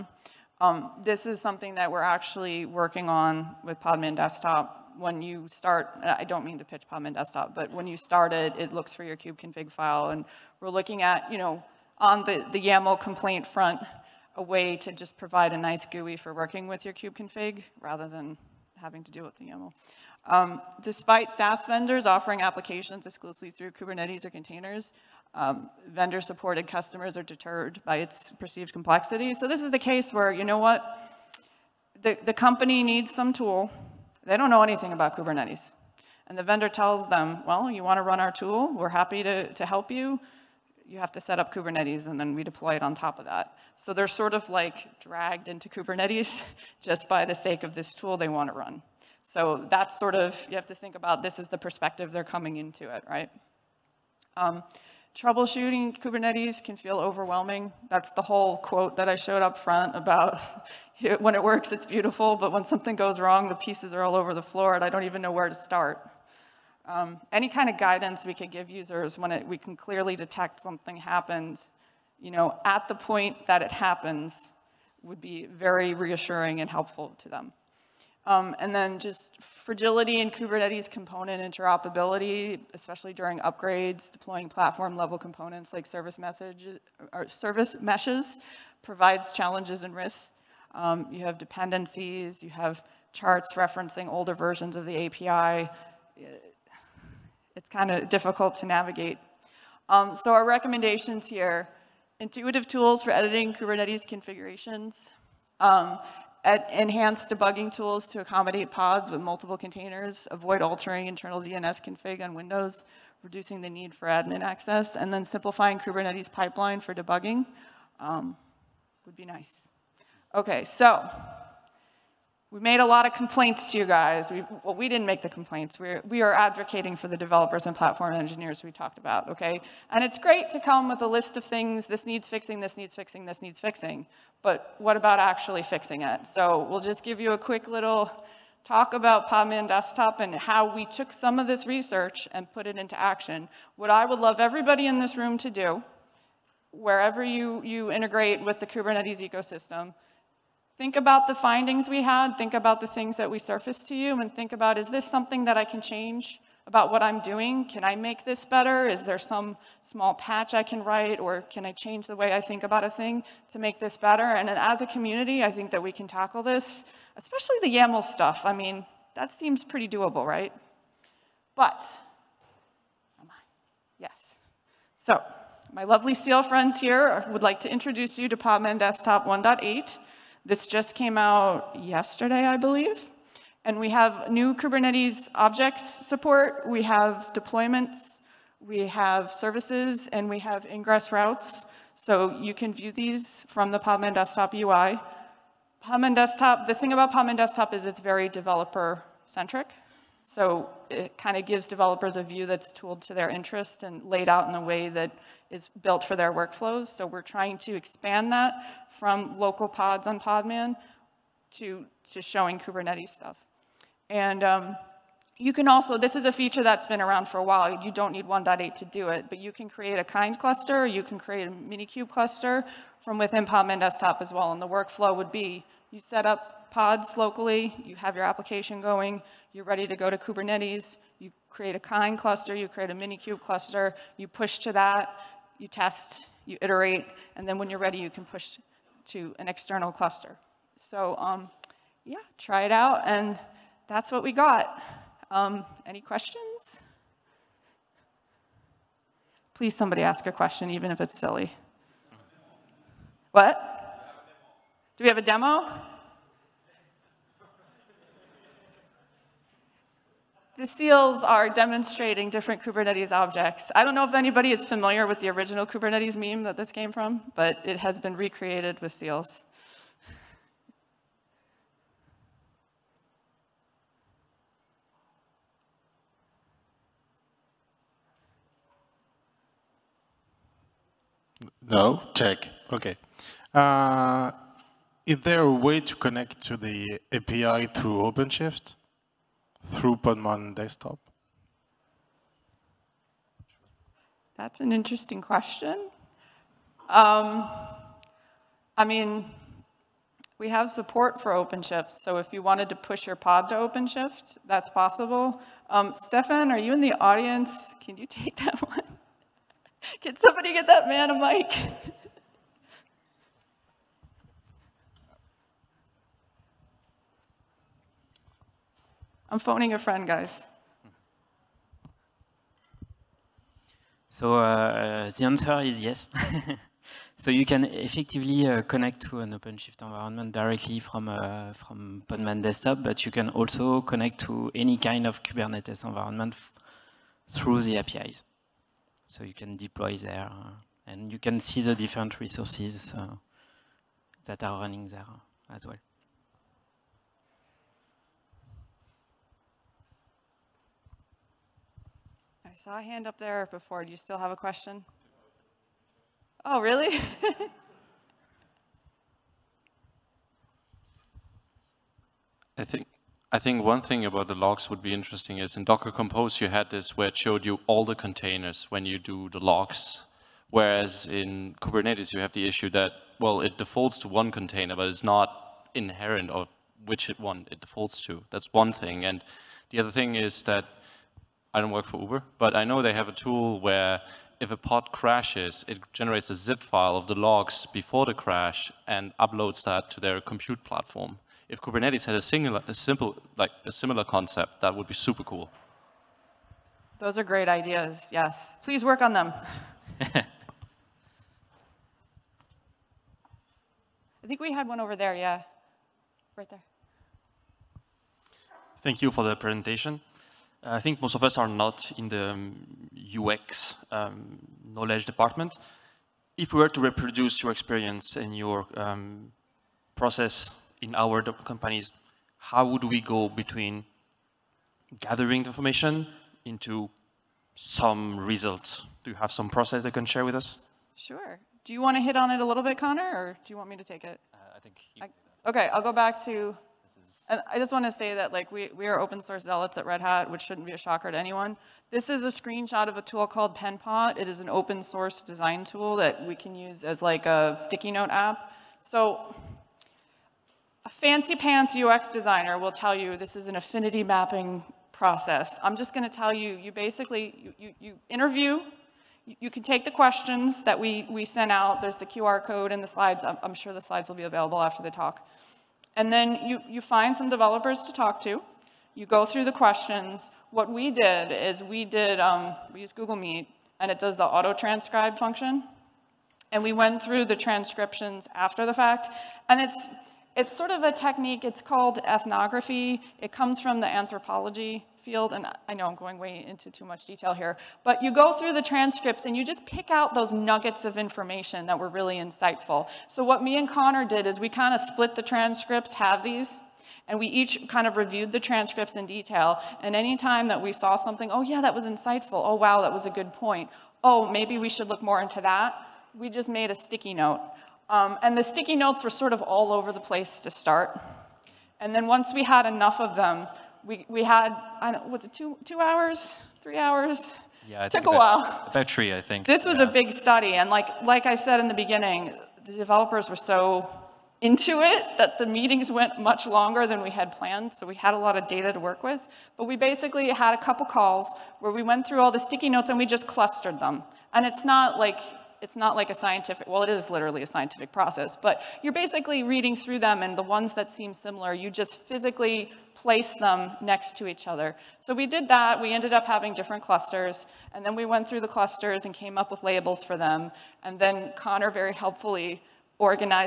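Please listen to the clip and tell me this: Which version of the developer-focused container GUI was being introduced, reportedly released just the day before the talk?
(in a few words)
1.8.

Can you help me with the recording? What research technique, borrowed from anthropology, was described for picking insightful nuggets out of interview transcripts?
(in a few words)
ethnography.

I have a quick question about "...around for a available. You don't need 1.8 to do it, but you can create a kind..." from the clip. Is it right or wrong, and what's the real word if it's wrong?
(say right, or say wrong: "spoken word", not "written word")
wrong: "while", not "available".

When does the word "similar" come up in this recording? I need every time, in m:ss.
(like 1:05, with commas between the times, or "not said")
6:33, 9:01.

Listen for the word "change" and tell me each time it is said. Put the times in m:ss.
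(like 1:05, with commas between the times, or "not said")
2:35, 2:41.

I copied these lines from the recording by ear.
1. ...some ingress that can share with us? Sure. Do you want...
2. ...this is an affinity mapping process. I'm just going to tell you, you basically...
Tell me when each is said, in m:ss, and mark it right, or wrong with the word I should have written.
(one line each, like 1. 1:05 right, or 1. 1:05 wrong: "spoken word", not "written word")
1. 7:09 wrong: "process", not "ingress"
2. 7:33 right.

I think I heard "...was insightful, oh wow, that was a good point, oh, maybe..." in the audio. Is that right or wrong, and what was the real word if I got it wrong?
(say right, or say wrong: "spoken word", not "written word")
right.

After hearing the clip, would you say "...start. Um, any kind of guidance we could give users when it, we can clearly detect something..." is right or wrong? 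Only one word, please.
right.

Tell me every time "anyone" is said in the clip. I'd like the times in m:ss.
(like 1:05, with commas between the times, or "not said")
7:21.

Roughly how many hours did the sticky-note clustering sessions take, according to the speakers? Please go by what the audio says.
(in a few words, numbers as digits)
3.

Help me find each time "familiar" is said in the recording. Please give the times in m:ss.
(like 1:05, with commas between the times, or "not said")
4:24.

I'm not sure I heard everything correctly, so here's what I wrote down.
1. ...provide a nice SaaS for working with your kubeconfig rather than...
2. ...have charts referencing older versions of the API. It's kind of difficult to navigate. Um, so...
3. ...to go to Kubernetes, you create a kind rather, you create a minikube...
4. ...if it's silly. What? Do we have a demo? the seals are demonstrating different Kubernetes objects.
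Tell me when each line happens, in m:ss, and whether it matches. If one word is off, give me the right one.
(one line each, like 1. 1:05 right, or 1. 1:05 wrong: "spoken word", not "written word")
1. 0:15 wrong: "GUI", not "SaaS"
2. 1:32 right
3. 3:49 wrong: "cluster", not "rather"
4. 4:10 right.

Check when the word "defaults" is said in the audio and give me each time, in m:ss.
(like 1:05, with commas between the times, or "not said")
6:13, 6:17.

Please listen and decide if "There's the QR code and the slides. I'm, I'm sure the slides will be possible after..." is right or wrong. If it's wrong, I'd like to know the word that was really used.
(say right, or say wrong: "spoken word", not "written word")
wrong: "available", not "possible".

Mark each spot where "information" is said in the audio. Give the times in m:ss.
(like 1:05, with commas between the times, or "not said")
7:05, 8:10.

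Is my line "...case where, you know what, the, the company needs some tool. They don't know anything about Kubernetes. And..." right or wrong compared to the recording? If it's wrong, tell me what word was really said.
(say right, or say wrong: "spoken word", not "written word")
right.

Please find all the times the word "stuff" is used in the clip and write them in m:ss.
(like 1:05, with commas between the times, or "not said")
2:48, 3:33.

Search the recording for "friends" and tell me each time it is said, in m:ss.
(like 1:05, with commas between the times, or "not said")
2:56, 5:19.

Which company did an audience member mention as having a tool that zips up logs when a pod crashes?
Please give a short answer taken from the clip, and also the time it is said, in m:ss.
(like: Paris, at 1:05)
Uber, at 6:22.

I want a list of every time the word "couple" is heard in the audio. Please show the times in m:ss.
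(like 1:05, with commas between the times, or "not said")
8:50.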